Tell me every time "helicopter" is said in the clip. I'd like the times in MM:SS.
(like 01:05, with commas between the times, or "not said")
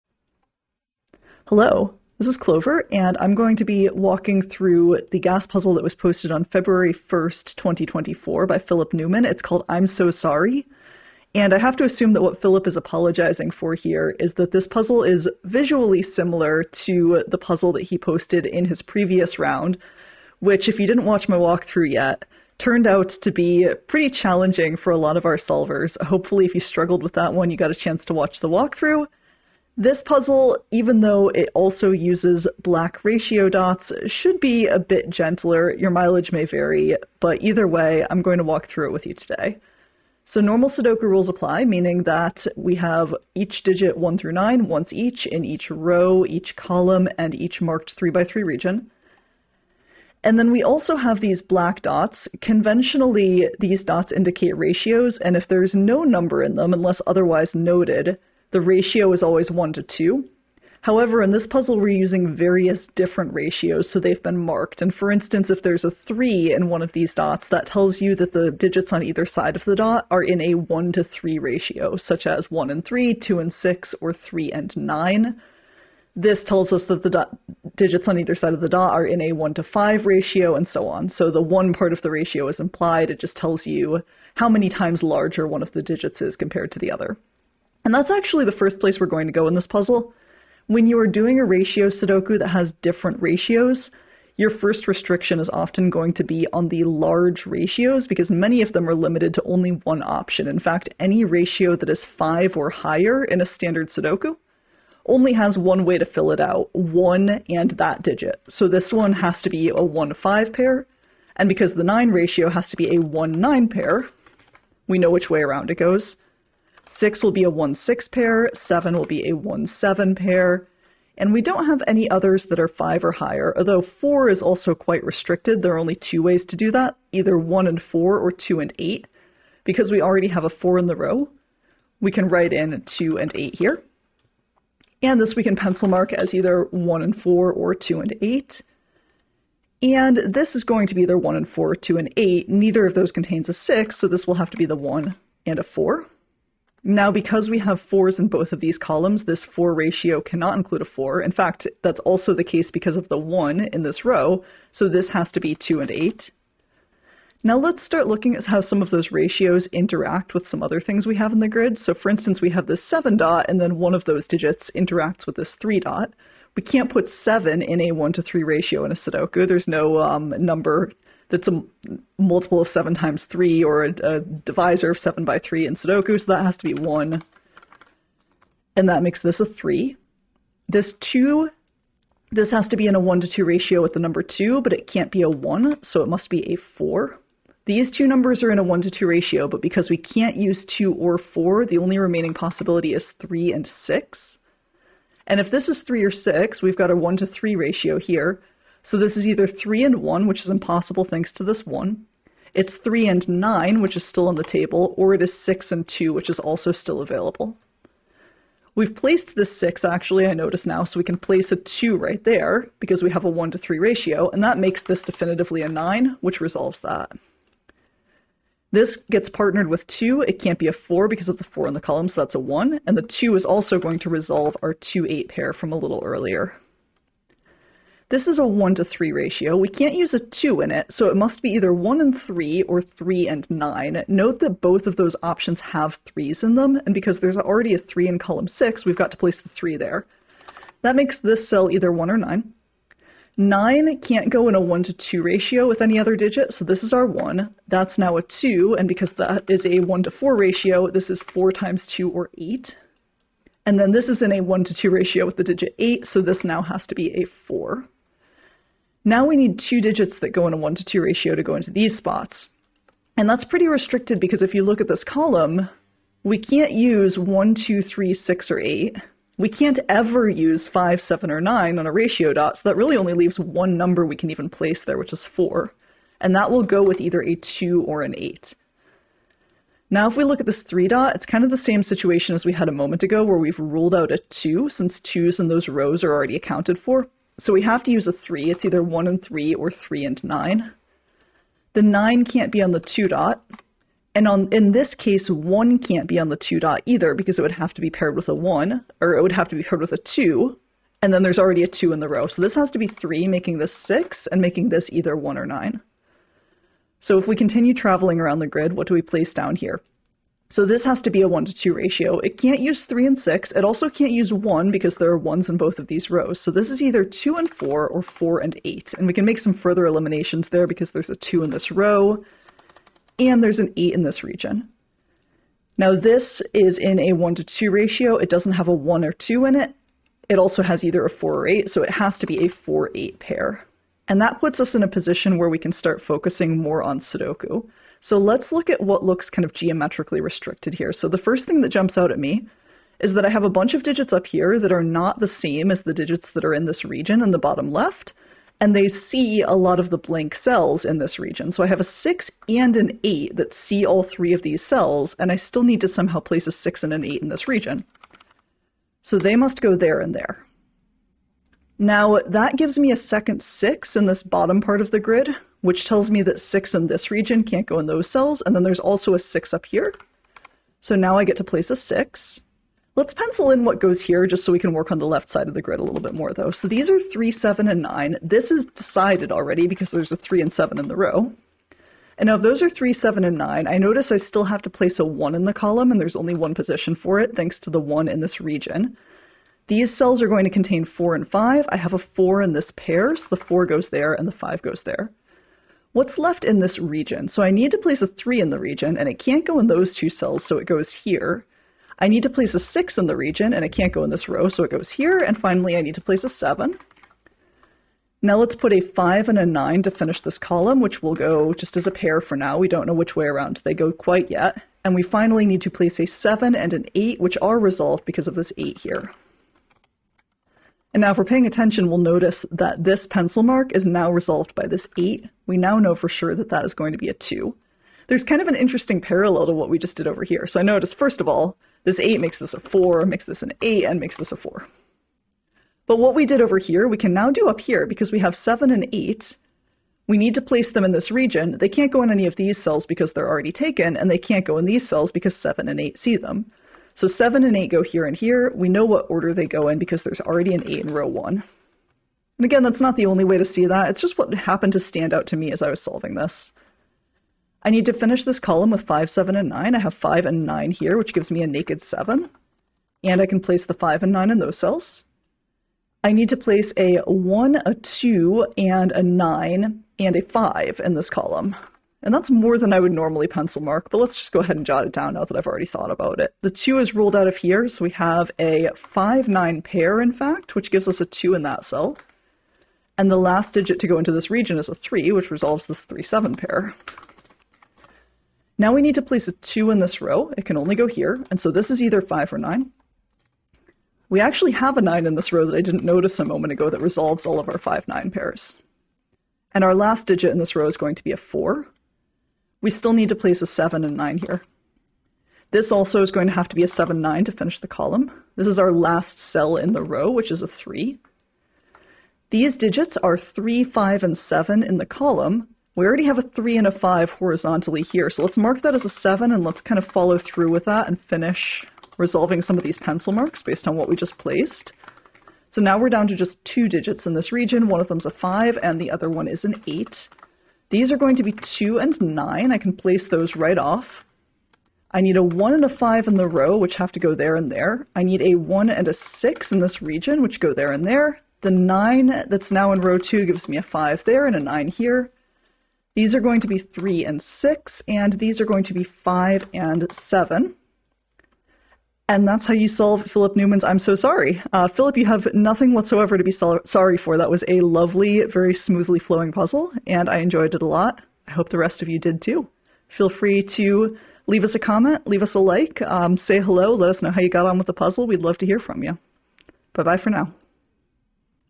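not said.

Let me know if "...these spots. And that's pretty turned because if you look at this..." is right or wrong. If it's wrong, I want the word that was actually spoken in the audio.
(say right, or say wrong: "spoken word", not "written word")
wrong: "restricted", not "turned".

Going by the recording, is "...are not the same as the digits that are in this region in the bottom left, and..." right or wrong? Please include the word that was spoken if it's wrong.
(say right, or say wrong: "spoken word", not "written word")
right.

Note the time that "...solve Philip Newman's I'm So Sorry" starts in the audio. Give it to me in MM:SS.
09:12.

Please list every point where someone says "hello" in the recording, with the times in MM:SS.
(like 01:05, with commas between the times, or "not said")
00:01, 09:26.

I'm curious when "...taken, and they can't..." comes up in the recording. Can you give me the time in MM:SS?
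07:23.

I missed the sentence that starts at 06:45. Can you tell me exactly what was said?
And finally, I need to place a 7.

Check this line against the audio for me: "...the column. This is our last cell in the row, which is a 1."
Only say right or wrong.
wrong.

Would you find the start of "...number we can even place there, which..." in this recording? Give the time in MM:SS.
04:33.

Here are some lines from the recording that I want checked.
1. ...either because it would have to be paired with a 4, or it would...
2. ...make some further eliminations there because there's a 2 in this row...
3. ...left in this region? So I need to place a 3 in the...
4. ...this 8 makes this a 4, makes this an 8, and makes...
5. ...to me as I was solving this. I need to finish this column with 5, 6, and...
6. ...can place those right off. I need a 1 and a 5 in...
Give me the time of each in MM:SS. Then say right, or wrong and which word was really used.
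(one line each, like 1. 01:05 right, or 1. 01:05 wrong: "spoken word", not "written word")
1. 04:56 wrong: "1", not "4"
2. 05:19 right
3. 06:36 right
4. 07:11 right
5. 07:35 wrong: "7", not "6"
6. 08:52 right.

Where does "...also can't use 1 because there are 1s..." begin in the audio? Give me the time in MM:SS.
05:13.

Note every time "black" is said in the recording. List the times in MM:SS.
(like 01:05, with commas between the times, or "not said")
00:32, 00:51.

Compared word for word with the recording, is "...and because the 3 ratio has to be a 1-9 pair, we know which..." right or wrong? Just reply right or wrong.
wrong.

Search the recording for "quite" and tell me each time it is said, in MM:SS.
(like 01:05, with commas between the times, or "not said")
02:04, 06:53.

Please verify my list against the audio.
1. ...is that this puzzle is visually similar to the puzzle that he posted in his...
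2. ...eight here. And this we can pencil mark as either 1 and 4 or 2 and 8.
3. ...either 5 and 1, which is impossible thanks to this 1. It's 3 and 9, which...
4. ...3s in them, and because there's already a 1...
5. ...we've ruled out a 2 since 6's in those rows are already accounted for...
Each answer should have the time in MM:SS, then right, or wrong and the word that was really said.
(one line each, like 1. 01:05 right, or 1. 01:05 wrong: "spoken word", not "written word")
1. 00:14 right
2. 02:13 right
3. 03:19 wrong: "3", not "5"
4. 03:56 wrong: "3", not "1"
5. 04:43 wrong: "2", not "6".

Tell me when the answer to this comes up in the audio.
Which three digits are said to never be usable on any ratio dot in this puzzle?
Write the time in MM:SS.
04:30.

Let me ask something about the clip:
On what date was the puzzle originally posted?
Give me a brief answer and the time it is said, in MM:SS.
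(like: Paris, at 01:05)
February 1st, 2024, at 00:06.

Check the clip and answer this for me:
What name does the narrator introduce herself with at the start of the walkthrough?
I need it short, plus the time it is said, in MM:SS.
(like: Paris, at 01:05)
Clover, at 00:02.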